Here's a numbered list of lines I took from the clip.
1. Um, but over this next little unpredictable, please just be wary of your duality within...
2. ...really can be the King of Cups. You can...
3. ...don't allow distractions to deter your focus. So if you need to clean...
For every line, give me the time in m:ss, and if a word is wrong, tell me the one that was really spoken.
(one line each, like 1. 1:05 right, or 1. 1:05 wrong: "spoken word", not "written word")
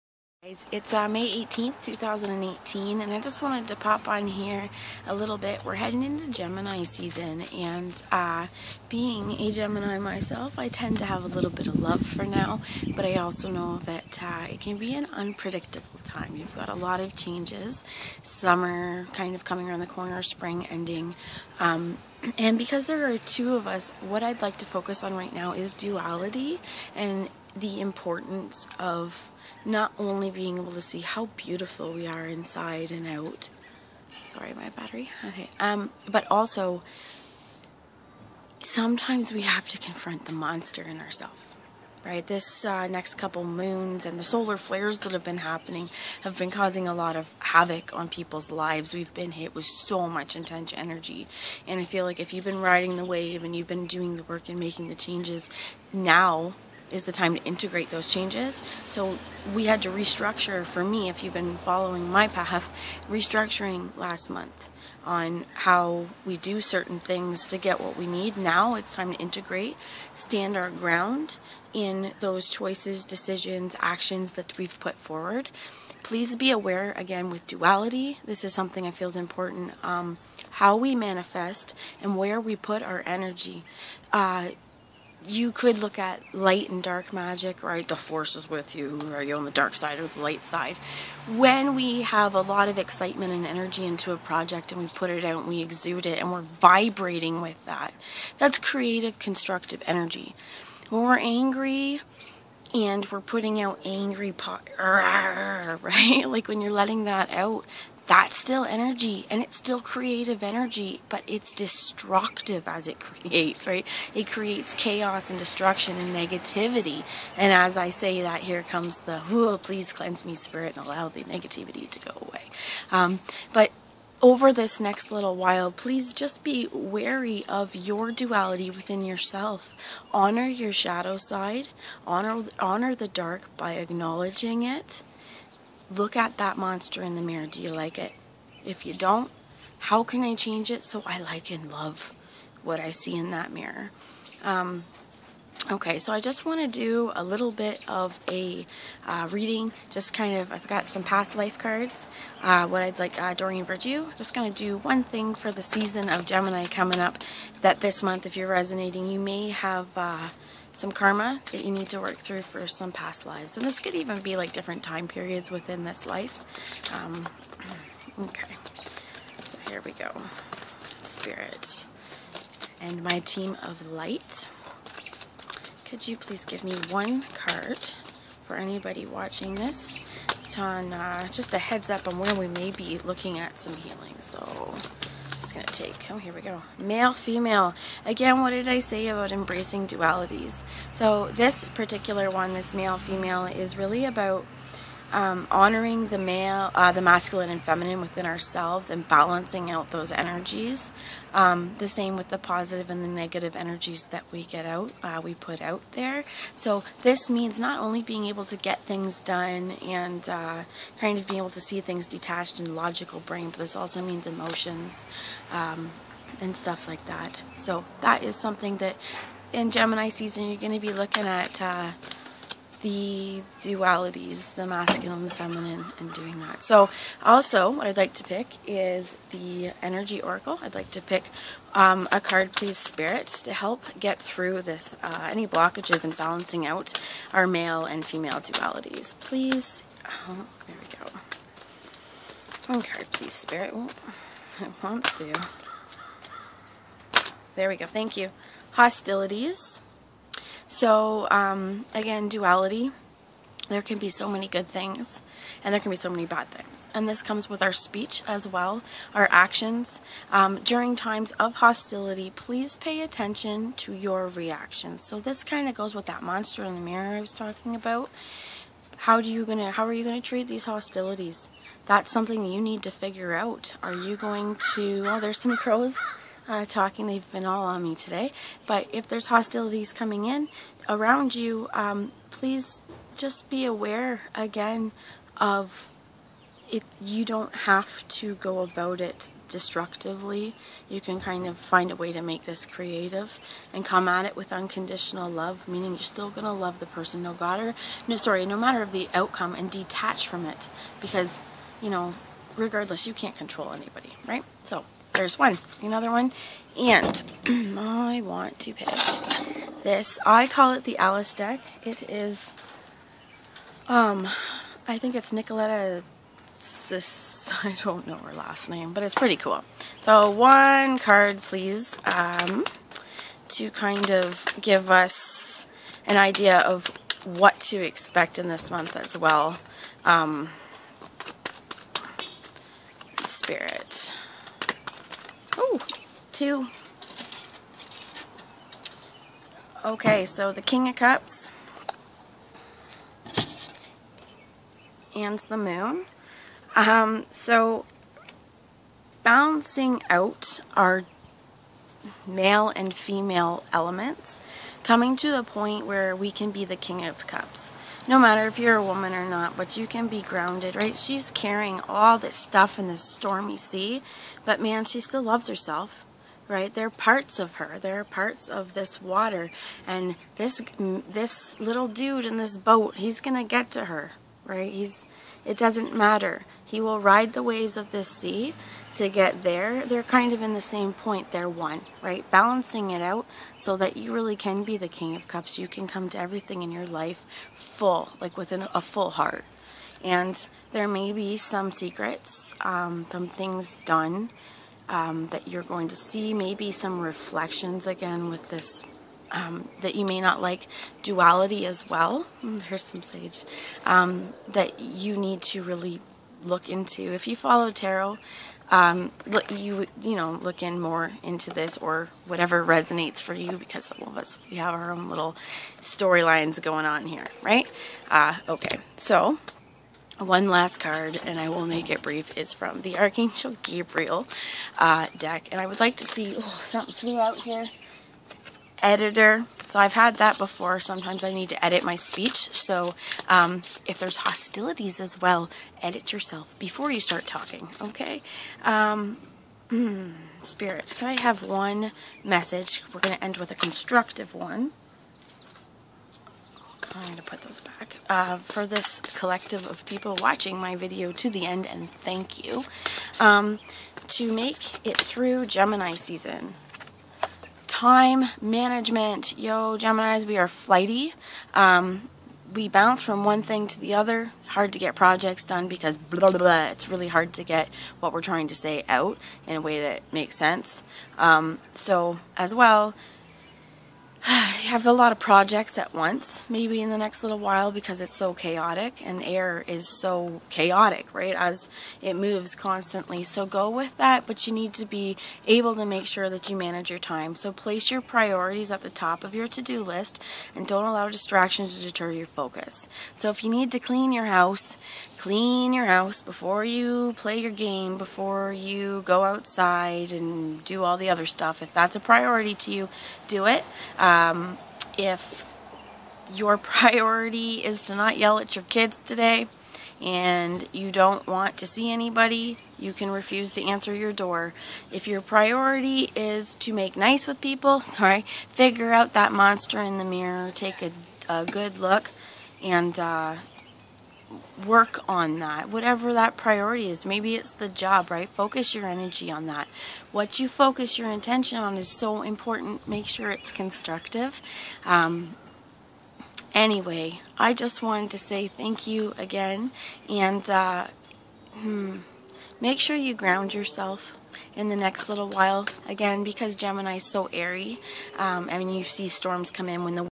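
1. 2:02 wrong: "while", not "unpredictable"
2. 6:24 right
3. 8:10 right.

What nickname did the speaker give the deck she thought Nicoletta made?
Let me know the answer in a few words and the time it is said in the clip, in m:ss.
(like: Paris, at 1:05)
The Alice deck, at 5:10.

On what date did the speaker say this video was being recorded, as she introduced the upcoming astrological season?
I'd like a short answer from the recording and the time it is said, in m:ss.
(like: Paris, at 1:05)
May 18th, 2018, at 0:01.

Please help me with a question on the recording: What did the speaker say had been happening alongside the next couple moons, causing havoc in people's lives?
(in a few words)
Solar flares.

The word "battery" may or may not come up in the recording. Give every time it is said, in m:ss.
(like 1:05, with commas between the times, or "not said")
0:34.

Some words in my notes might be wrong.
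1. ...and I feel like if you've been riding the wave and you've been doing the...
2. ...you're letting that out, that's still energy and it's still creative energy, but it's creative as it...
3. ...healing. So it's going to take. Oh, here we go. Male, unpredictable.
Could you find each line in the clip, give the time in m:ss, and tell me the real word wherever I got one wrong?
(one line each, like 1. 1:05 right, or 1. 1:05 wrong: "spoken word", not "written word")
1. 0:51 right
2. 1:46 wrong: "destructive", not "creative"
3. 3:03 wrong: "female", not "unpredictable".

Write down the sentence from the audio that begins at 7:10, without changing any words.
Sometimes I need to edit my speech.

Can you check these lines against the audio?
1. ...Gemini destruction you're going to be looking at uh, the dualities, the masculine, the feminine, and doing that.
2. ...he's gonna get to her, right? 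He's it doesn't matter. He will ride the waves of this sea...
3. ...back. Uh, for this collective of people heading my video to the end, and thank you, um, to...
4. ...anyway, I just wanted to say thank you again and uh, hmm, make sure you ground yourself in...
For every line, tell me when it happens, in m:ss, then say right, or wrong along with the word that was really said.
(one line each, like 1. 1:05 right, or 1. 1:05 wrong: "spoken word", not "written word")
1. 3:39 wrong: "season", not "destruction"
2. 6:12 right
3. 7:27 wrong: "watching", not "heading"
4. 8:56 right.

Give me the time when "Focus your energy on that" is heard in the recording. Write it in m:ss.
8:48.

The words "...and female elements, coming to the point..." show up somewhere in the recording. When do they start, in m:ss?
5:52.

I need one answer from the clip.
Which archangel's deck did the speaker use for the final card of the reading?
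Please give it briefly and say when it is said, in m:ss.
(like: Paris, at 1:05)
Gabriel, at 7:02.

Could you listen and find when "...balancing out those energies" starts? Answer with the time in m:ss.
3:19.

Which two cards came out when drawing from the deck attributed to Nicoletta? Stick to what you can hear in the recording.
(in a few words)
King of Cups and the Moon.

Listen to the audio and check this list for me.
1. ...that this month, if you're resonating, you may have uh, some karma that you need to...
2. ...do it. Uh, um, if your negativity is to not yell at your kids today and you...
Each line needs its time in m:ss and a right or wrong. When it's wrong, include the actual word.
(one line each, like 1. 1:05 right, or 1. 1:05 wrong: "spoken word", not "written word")
1. 2:37 right
2. 8:23 wrong: "priority", not "negativity".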